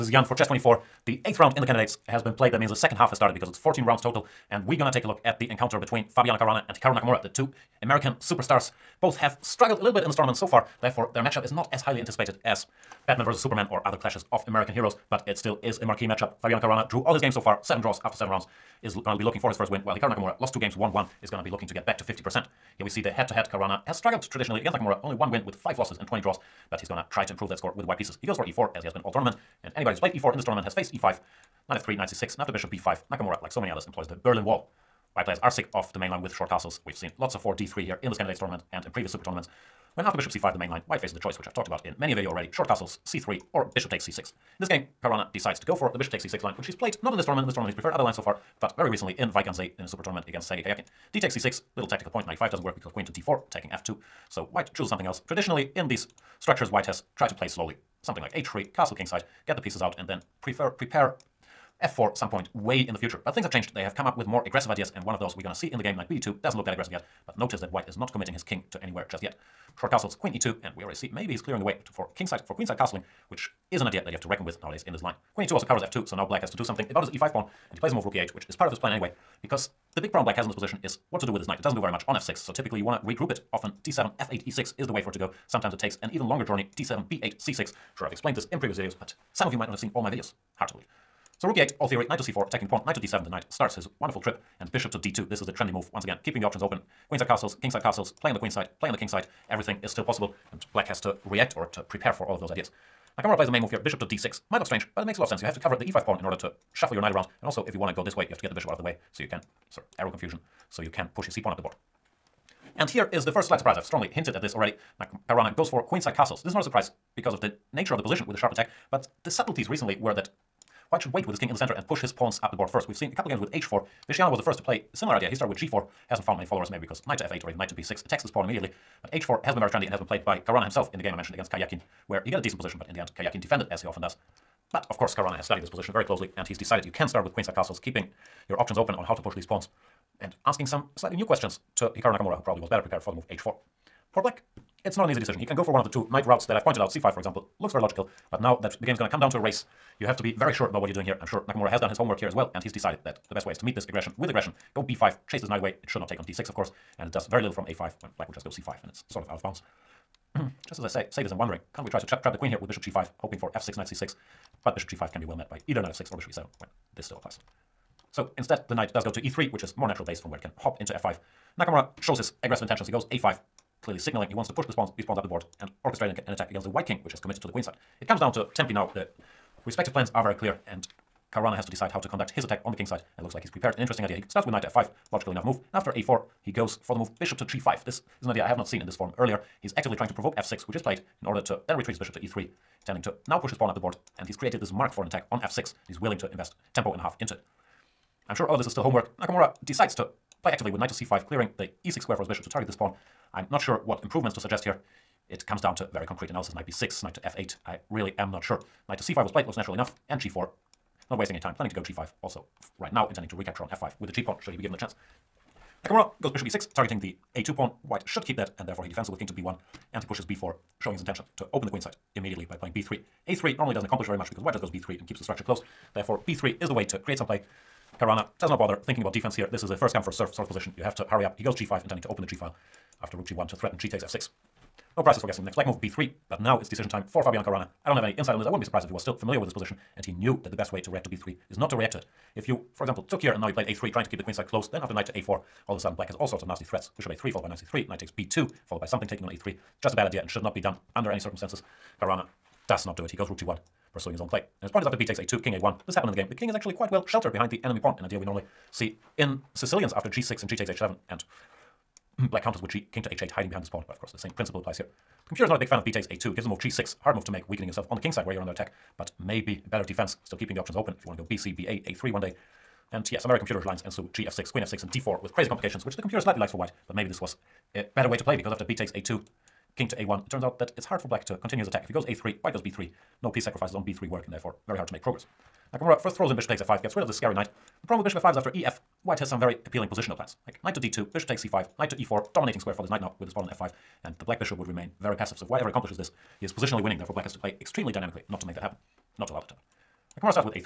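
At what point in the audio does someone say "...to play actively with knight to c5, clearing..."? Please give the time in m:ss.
3:19.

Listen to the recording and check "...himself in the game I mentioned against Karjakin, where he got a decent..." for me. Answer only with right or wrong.
right.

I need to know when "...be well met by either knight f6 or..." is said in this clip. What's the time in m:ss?
2:45.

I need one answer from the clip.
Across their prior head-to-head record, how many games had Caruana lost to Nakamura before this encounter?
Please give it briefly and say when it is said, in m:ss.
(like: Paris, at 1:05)
5, at 0:25.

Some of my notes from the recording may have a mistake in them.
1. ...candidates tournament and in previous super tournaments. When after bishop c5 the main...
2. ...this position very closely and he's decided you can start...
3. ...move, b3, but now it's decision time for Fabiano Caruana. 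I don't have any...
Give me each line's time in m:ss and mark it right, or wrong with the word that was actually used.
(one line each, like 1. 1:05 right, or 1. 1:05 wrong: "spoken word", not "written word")
1. 0:38 right
2. 2:15 right
3. 3:55 right.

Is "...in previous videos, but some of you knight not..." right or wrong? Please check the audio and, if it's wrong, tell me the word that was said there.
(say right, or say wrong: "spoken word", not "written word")
wrong: "might", not "knight".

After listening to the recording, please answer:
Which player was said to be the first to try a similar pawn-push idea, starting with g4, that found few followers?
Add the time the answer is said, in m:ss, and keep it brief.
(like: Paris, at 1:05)
Visciano, at 2:04.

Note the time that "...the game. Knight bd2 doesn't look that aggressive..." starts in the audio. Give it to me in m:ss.
1:05.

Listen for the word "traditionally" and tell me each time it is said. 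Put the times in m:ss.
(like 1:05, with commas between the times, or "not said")
0:24, 0:55.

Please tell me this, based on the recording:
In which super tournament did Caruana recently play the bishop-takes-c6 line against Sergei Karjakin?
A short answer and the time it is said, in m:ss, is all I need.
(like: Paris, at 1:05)
Wijk aan Zee, at 0:49.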